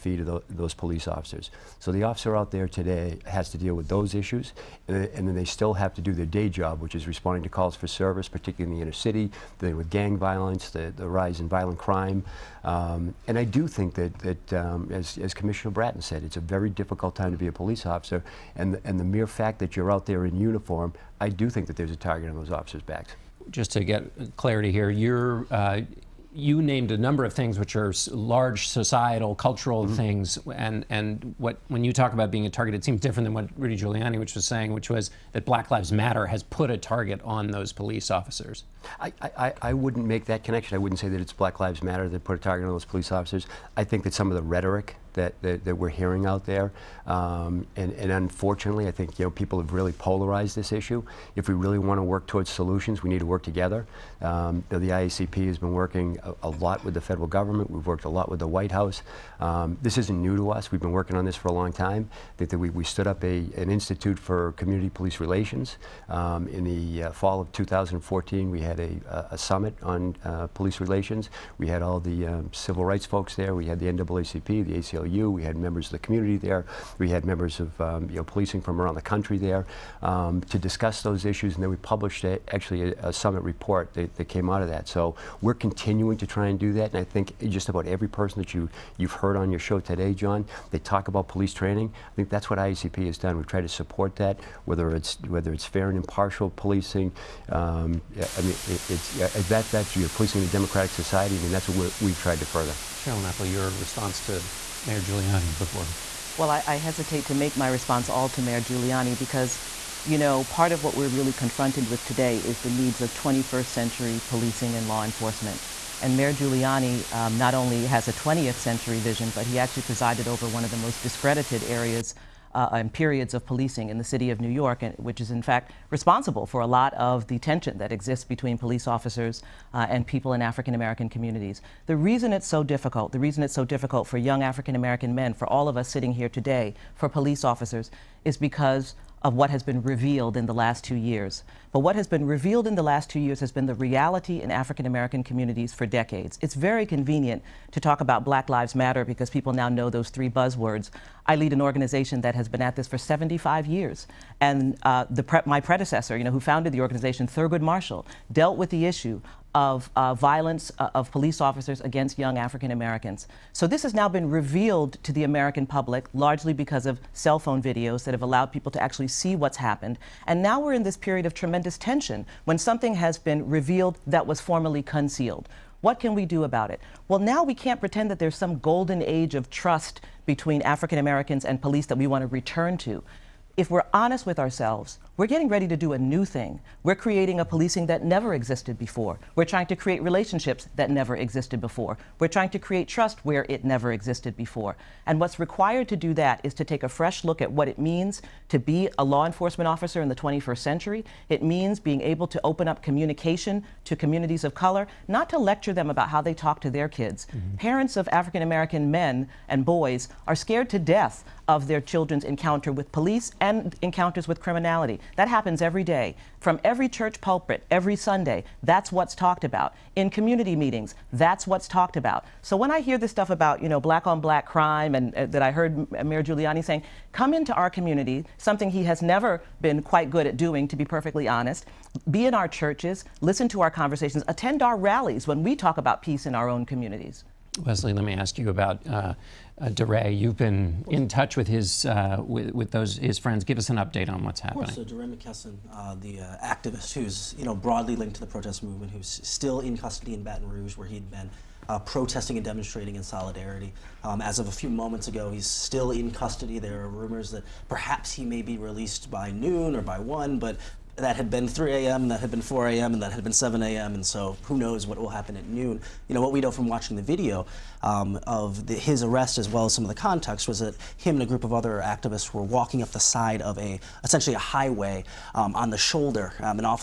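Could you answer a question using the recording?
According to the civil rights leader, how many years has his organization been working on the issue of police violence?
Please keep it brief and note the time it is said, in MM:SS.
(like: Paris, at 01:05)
75, at 02:32.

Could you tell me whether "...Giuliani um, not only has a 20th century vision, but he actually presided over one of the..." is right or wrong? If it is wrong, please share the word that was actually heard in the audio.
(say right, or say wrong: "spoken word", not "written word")
right.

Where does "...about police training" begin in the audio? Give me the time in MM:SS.
01:31.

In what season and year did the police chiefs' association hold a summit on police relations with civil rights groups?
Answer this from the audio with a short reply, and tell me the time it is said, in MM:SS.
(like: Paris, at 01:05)
Fall of 2014, at 01:07.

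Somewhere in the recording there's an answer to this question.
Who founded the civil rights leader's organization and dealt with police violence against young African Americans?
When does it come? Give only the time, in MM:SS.
02:37.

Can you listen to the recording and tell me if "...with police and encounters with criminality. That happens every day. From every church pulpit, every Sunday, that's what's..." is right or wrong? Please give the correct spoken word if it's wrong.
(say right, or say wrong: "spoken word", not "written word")
right.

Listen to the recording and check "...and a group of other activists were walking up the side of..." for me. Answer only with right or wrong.
right.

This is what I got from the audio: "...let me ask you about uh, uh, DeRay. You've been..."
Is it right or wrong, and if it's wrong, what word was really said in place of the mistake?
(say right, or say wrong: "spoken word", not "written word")
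right.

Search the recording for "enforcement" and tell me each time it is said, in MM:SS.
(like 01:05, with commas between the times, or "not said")
01:55, 03:19.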